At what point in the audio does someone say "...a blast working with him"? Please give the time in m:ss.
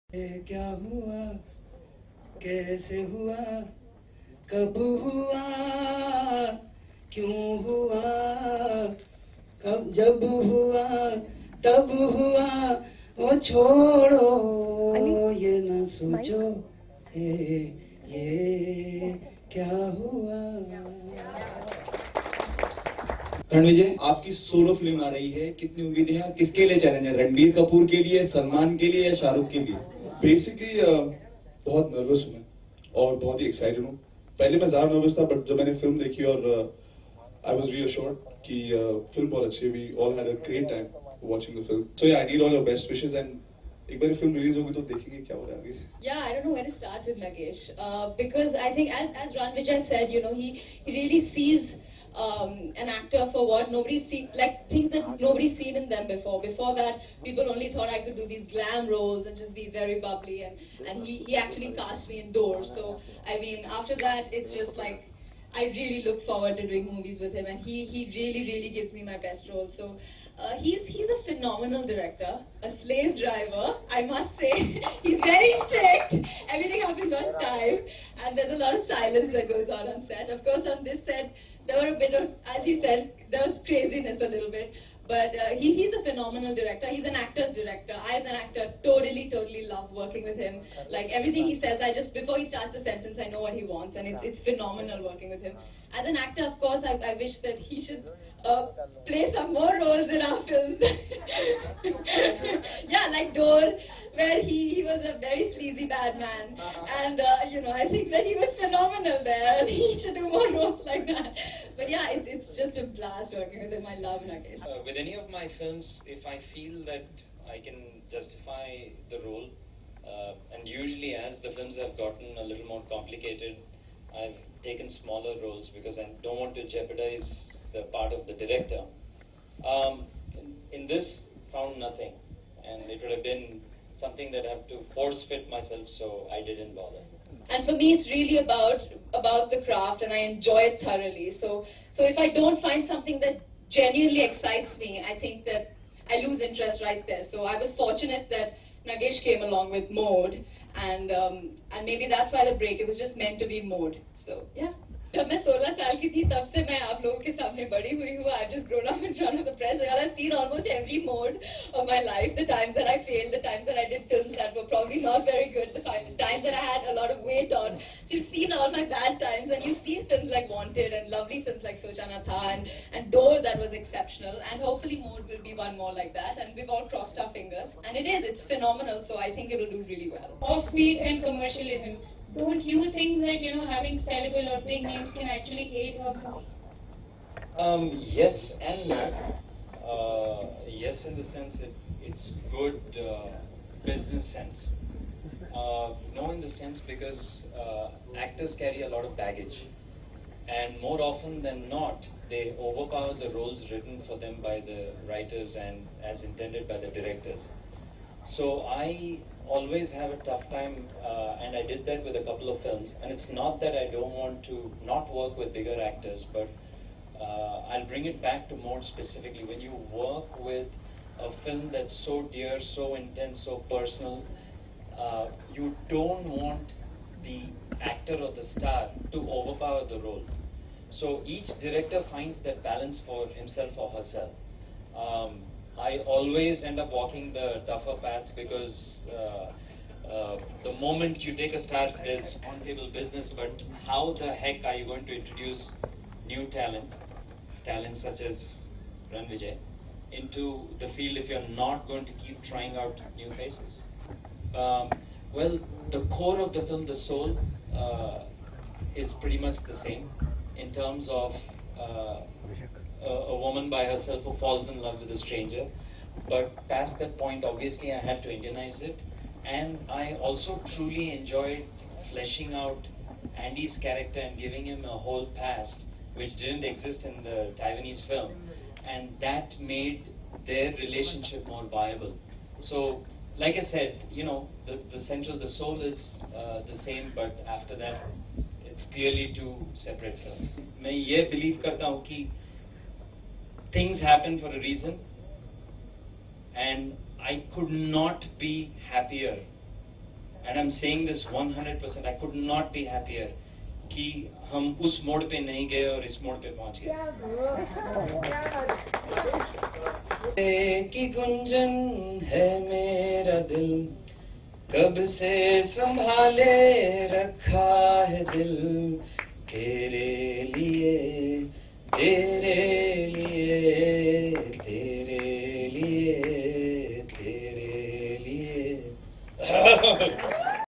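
1:52.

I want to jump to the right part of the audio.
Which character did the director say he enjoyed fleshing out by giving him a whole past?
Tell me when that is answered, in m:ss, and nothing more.
4:33.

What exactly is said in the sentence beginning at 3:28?
So I always have a tough time, uh, and I did that with a couple of films.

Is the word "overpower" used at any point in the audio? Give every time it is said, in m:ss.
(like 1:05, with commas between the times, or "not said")
3:22, 3:49.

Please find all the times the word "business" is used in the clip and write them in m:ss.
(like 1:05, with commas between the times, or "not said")
3:13, 4:02.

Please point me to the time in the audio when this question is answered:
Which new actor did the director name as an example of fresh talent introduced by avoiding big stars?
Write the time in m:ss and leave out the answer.
4:09.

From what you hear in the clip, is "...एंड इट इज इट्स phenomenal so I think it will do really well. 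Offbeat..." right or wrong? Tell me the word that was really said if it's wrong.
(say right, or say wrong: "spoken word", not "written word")
right.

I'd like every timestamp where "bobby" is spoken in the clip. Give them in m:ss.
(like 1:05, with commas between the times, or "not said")
not said.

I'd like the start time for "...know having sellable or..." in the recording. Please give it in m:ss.
3:03.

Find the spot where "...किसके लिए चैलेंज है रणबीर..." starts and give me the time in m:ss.
0:26.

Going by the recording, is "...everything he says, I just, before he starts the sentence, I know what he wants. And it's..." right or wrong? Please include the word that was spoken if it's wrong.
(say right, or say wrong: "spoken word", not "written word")
right.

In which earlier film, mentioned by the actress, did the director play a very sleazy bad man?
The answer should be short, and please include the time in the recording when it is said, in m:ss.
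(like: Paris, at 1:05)
Dole, at 1:43.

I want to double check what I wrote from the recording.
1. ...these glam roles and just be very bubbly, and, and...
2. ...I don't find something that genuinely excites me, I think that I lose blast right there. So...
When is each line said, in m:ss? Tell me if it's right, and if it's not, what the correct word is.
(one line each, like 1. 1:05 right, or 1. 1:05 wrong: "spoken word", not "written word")
1. 0:58 right
2. 2:22 wrong: "interest", not "blast".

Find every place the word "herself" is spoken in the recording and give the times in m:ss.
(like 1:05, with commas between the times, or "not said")
3:53, 4:23.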